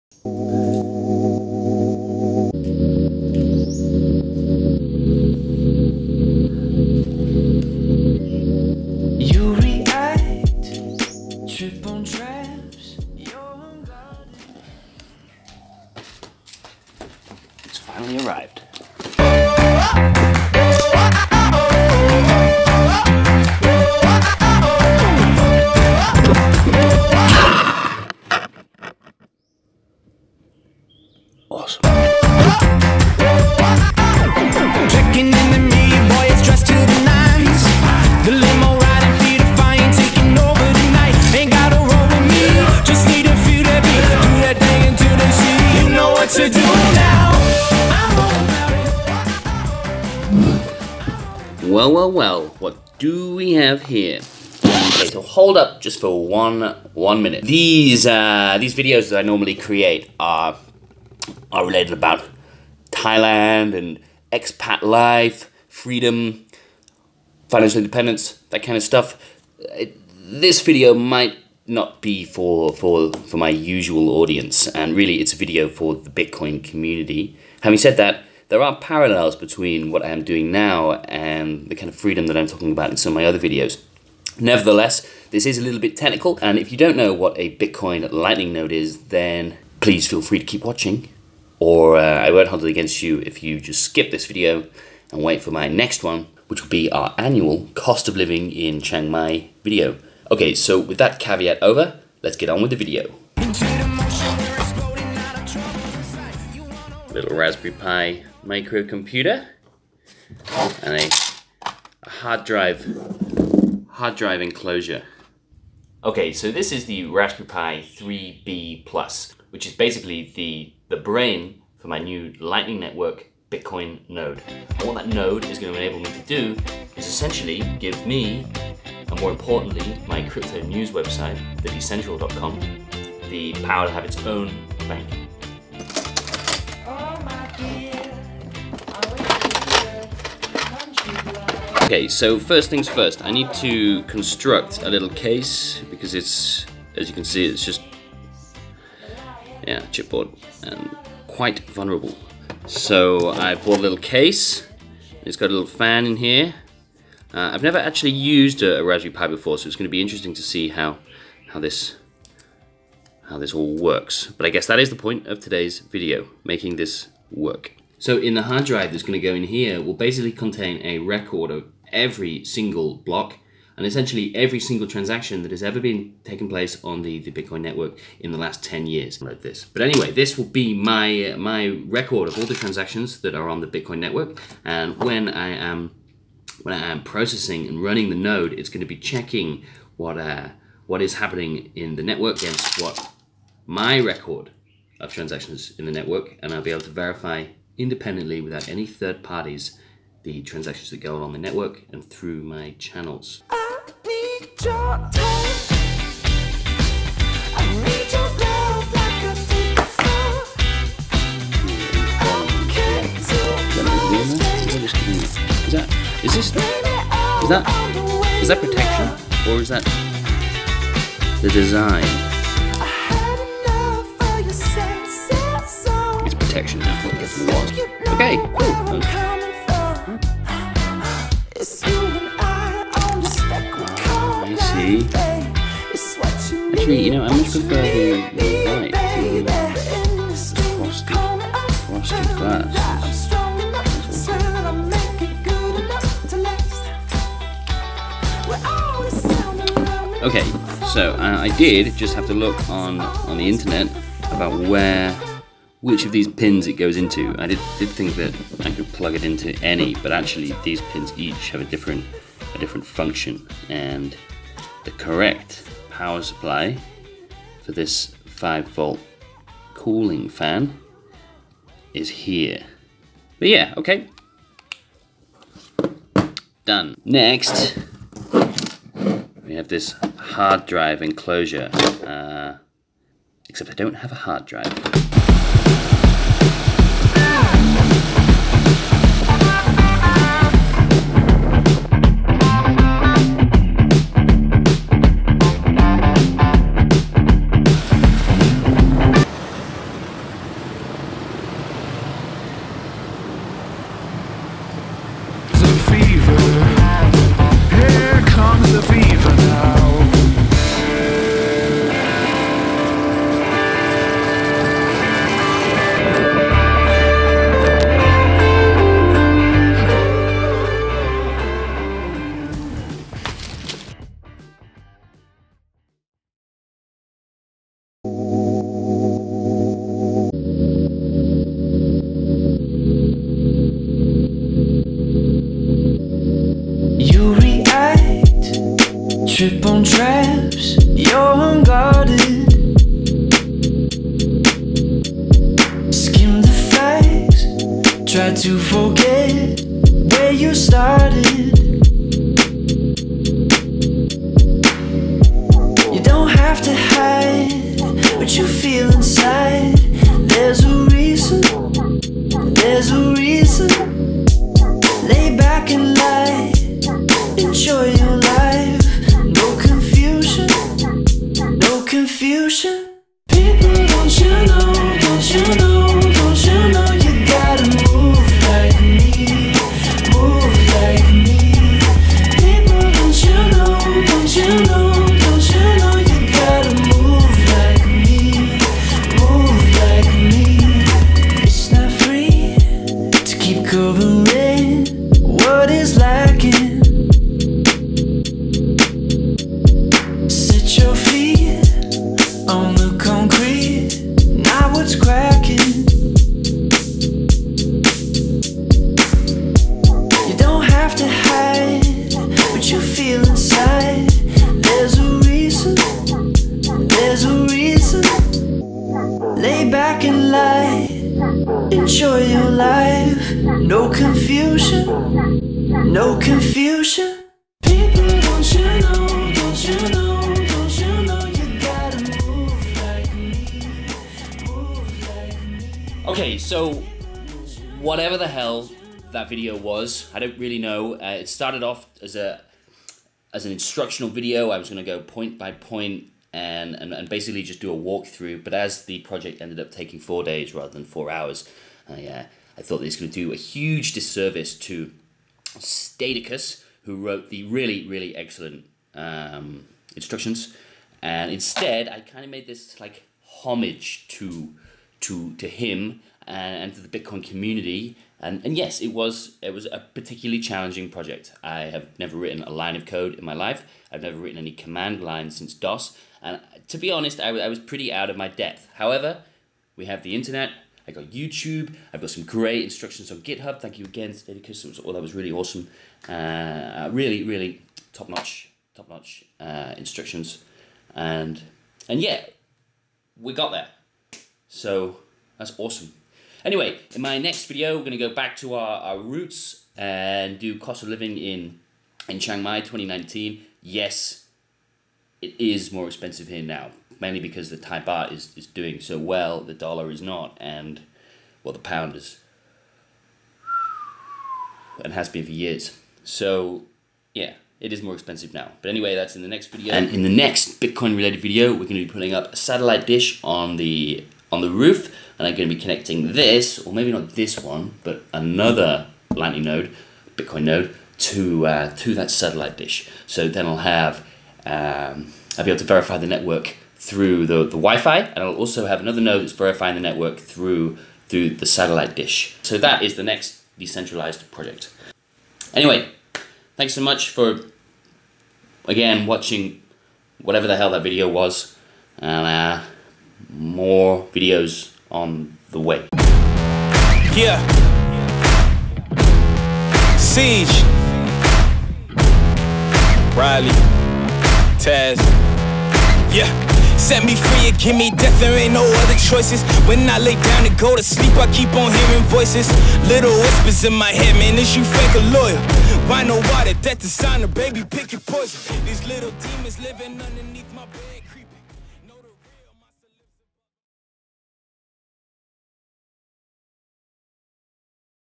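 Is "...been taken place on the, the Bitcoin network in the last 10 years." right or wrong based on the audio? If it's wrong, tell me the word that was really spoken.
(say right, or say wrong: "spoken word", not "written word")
right.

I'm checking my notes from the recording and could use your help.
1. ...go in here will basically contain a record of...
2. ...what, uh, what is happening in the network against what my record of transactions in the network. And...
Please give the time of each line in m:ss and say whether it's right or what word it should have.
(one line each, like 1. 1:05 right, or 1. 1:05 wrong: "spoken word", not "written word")
1. 2:49 right
2. 3:09 right.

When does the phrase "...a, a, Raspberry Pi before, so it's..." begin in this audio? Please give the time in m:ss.
2:38.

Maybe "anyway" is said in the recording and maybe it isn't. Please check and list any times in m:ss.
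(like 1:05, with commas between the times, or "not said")
2:59, 8:16, 8:38, 9:05.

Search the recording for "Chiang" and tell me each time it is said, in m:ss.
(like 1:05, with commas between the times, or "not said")
1:38, 8:22.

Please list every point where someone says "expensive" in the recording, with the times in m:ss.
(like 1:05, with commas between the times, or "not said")
8:25, 8:37.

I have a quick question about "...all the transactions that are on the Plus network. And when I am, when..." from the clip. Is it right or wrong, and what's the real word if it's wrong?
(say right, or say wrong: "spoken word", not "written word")
wrong: "Bitcoin", not "Plus".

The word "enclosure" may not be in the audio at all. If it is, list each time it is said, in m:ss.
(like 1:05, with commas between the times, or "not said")
1:54, 4:41.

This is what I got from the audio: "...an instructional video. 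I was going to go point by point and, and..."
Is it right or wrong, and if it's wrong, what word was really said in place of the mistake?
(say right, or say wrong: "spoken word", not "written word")
right.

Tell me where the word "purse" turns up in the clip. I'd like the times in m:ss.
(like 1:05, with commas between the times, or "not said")
not said.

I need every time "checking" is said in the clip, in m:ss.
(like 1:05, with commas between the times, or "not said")
3:08.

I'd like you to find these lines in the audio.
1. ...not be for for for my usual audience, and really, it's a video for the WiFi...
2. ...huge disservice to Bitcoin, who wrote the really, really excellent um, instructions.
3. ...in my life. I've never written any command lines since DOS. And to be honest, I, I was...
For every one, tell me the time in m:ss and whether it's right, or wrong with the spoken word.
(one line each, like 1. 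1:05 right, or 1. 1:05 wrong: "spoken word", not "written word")
1. 1:11 wrong: "Bitcoin", not "WiFi"
2. 7:33 wrong: "Stadicus", not "Bitcoin"
3. 7:53 right.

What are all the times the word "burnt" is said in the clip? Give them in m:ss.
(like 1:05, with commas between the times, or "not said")
not said.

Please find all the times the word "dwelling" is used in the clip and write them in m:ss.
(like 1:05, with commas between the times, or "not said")
not said.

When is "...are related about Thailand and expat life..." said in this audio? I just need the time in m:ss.
1:01.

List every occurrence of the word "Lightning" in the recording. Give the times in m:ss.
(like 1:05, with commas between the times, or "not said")
1:28, 2:02, 8:49.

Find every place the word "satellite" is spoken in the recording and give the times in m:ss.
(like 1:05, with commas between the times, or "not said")
8:42, 8:52, 9:01.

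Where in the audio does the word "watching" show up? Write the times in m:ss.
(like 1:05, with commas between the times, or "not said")
1:30, 9:09.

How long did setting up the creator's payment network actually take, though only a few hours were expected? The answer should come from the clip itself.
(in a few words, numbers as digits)
four days.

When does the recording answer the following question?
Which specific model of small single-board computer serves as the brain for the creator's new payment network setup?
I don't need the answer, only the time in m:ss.
1:57.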